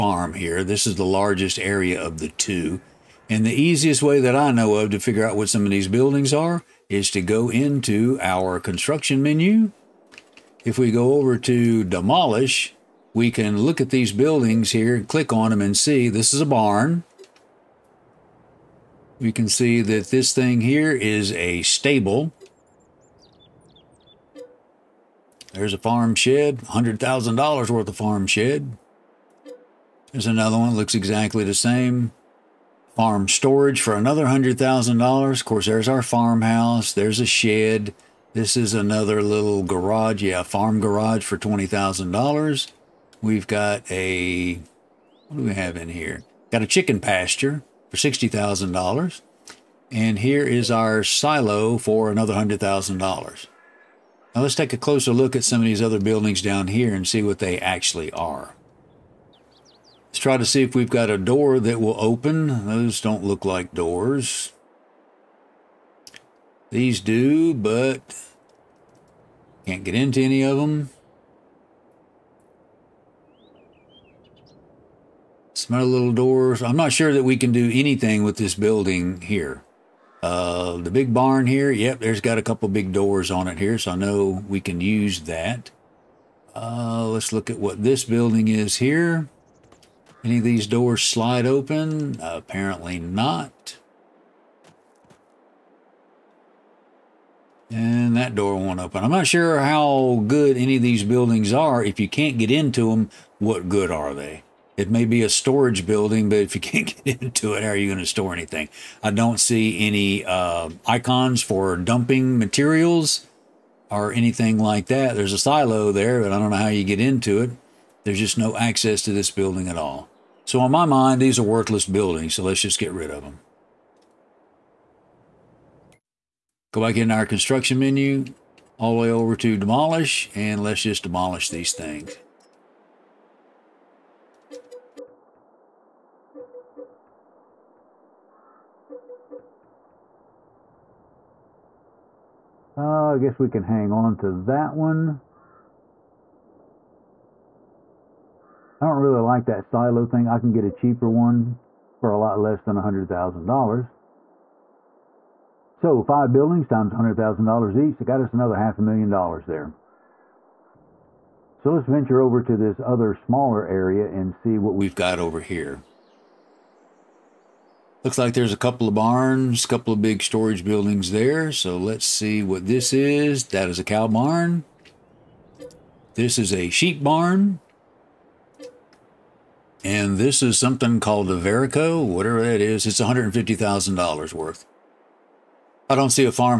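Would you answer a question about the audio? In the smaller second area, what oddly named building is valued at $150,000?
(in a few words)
Verico.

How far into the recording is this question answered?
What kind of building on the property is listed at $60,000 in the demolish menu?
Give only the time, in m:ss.
0:46.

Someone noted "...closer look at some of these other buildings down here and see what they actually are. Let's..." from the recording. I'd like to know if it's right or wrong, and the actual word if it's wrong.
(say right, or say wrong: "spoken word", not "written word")
right.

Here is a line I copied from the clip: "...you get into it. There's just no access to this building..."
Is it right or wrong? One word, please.
right.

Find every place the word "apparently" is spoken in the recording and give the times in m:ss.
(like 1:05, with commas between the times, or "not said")
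1:32.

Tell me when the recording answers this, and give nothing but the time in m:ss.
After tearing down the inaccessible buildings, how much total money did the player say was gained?
2:38.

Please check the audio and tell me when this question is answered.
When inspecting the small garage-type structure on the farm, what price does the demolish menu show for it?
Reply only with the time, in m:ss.
0:41.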